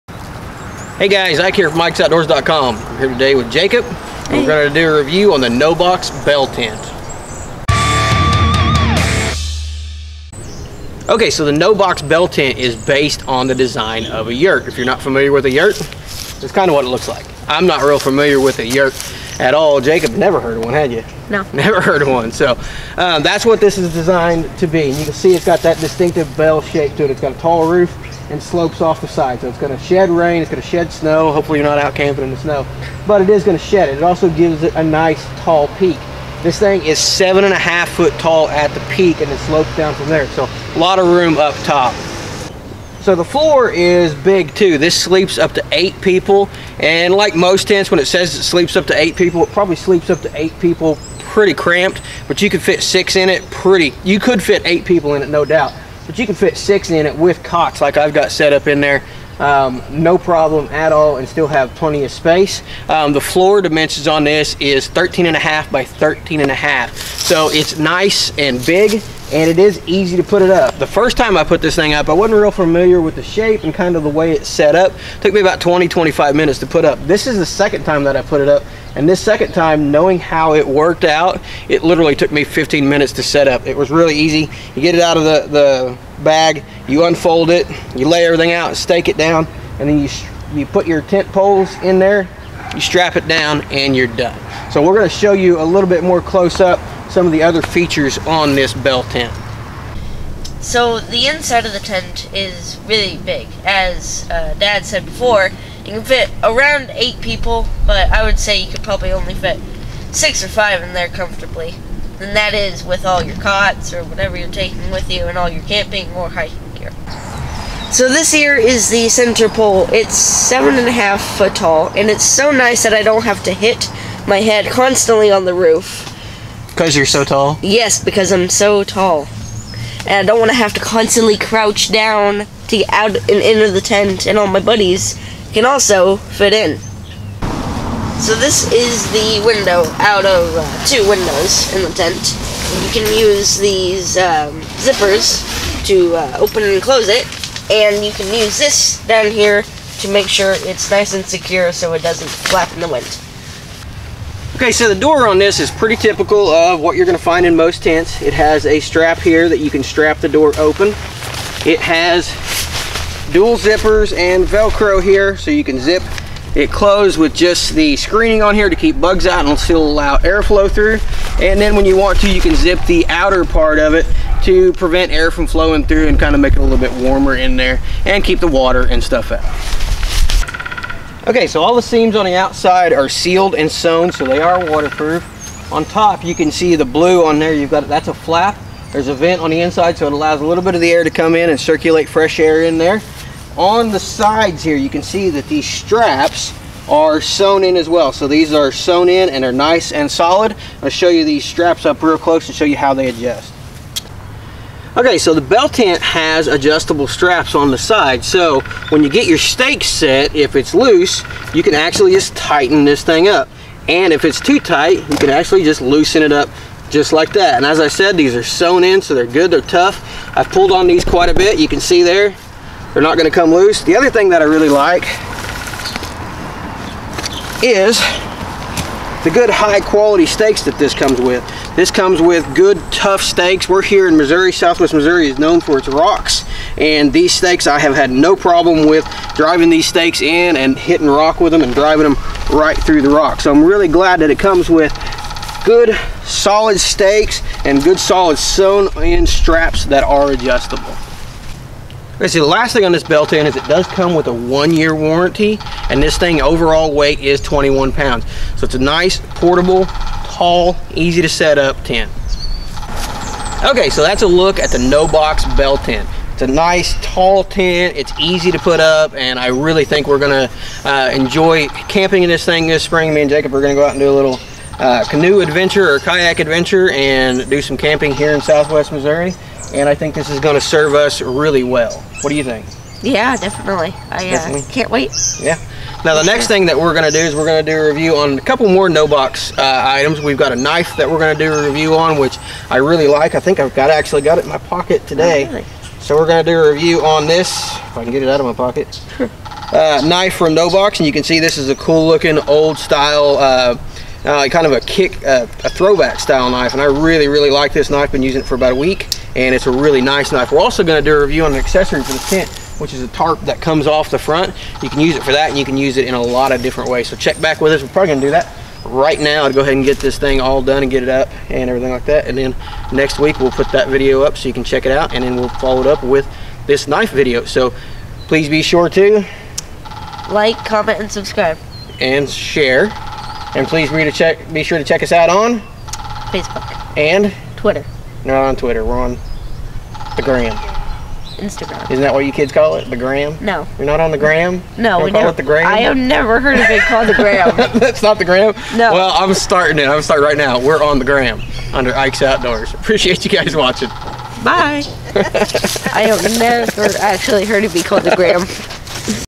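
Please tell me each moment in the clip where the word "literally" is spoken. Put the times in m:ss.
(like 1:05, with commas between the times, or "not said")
1:21.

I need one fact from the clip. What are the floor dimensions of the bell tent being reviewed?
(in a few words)
13.5 by 13.5.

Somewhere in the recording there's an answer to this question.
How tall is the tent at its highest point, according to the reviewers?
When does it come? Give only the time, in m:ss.
0:36.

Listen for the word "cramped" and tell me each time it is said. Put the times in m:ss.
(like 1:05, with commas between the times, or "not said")
0:51.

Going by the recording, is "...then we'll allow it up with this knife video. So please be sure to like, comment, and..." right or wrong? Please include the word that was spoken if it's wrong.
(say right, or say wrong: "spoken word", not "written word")
wrong: "follow", not "allow".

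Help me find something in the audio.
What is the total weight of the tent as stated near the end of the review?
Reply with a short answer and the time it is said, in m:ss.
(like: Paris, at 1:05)
21 pounds, at 4:17.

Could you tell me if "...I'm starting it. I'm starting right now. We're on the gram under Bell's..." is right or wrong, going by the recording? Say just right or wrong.
wrong.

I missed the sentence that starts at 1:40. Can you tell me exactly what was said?
So the inside of the tent is really big.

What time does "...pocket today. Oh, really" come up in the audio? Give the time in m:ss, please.
4:54.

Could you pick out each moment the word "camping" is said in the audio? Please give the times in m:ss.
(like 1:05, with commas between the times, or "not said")
0:31, 1:55, 4:31, 4:37.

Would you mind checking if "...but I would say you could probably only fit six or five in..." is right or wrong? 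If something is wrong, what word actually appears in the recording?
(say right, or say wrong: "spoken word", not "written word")
right.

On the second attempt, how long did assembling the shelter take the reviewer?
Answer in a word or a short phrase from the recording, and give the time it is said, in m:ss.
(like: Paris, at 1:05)
15 minutes, at 1:22.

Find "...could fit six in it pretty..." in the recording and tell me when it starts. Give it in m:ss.
0:52.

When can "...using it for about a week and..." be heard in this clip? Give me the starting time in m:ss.
5:08.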